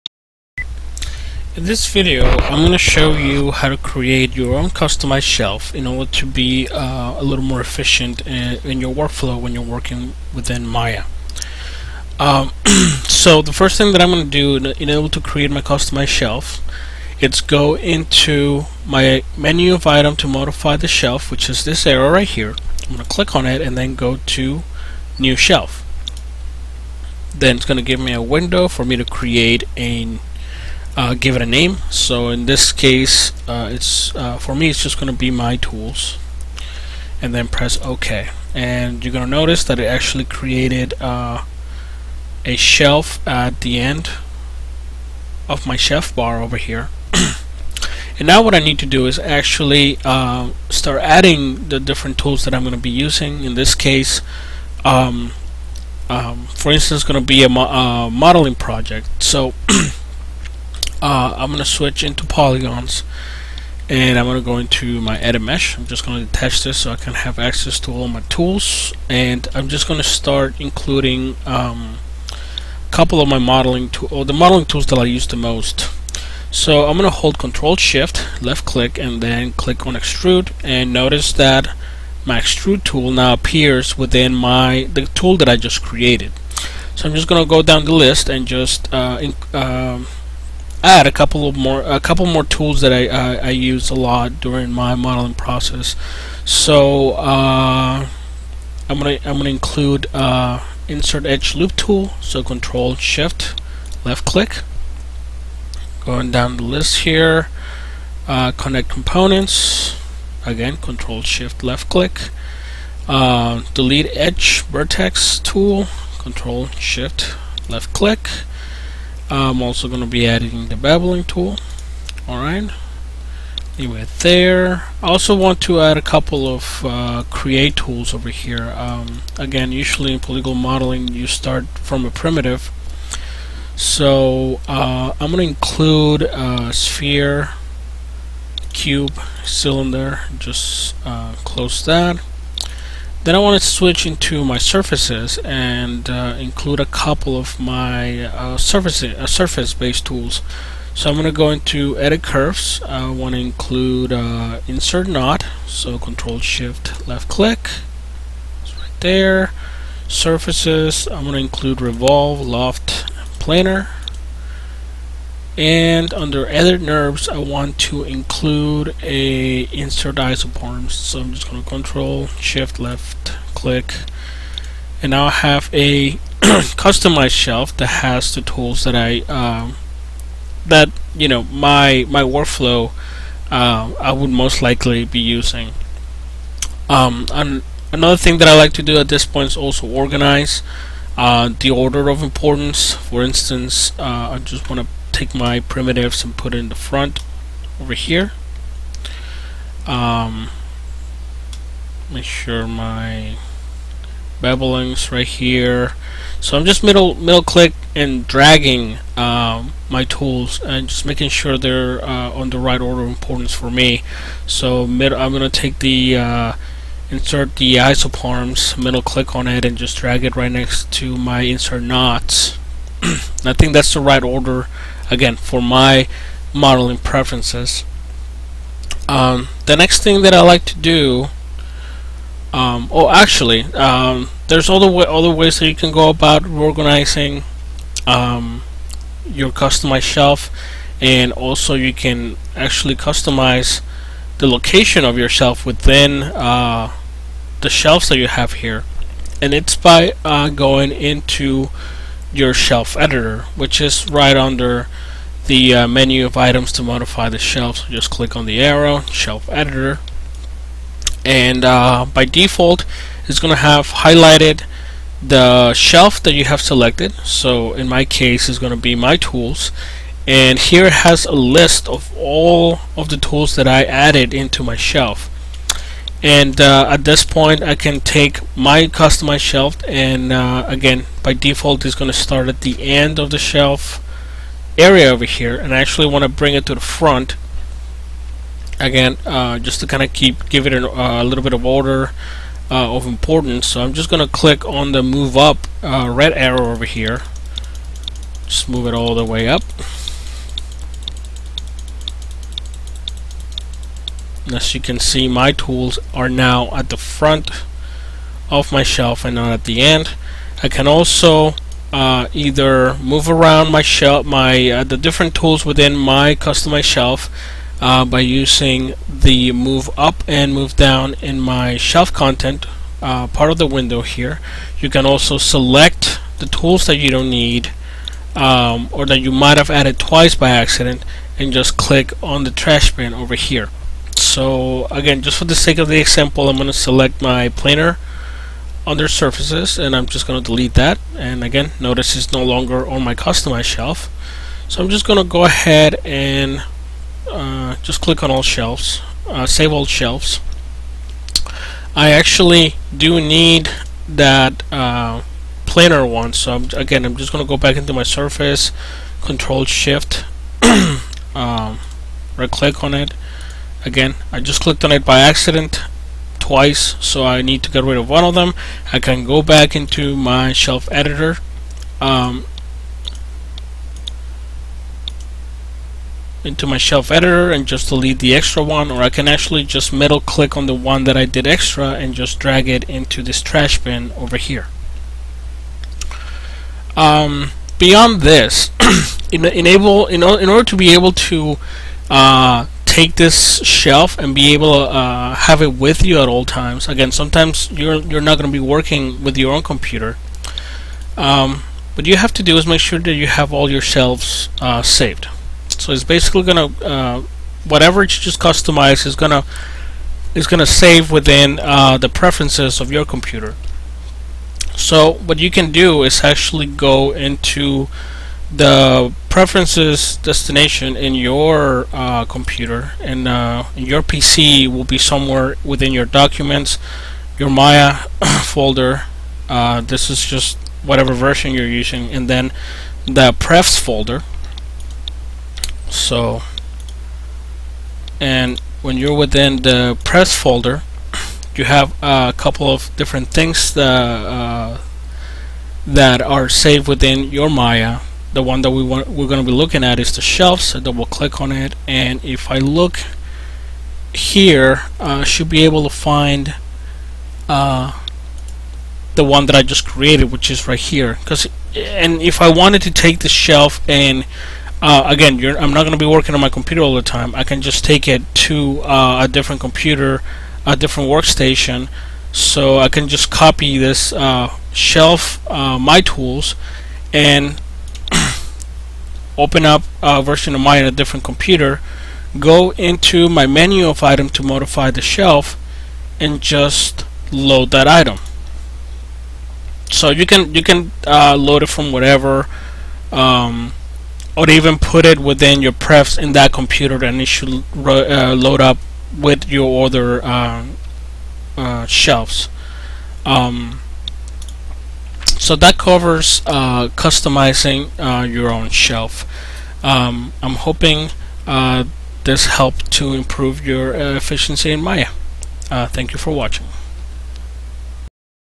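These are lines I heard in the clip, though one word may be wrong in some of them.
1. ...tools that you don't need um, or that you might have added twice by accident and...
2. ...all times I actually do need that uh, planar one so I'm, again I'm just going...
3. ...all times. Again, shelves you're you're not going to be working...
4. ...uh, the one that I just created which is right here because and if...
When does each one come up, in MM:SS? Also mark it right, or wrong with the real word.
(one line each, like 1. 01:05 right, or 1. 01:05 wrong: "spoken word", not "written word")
1. 05:26 right
2. 05:49 wrong: "shelves", not "times"
3. 06:36 wrong: "sometimes", not "shelves"
4. 07:37 right.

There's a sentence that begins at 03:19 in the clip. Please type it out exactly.
Um, make sure my bevelings right here.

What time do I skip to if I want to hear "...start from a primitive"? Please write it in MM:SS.
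02:11.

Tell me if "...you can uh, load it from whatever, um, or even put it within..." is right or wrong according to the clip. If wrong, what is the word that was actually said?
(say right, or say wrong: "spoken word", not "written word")
right.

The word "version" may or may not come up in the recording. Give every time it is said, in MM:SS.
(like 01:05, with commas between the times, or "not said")
07:11, 08:00.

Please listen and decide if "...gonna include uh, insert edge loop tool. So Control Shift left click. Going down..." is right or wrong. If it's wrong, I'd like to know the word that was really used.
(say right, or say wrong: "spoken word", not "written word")
right.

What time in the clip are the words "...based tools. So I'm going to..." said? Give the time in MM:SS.
02:29.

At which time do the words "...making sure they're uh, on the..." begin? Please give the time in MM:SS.
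03:31.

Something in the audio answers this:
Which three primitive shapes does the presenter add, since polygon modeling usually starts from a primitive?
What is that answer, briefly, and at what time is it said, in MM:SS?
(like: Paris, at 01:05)
sphere, cube, cylinder, at 02:16.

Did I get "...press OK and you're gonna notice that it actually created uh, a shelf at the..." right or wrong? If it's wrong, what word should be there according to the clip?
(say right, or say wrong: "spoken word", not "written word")
right.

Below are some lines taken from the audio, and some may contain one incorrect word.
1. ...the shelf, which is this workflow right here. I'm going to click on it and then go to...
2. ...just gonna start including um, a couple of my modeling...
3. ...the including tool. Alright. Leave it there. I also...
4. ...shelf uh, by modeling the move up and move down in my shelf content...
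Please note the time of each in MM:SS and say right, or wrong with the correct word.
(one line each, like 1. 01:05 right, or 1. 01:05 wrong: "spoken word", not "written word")
1. 00:20 wrong: "arrow", not "workflow"
2. 01:09 right
3. 02:00 wrong: "beveling", not "including"
4. 05:16 wrong: "using", not "modeling".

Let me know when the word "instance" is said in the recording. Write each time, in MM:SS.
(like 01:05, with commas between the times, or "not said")
00:56, 03:13.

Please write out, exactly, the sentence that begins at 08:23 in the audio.
Um, so that covers uh, customizing uh, your own shelf.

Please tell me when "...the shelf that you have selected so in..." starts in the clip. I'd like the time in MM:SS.
04:25.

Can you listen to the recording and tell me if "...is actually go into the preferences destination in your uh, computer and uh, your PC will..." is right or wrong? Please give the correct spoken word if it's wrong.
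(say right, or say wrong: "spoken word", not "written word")
right.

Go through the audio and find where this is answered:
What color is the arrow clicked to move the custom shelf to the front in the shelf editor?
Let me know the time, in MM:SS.
04:56.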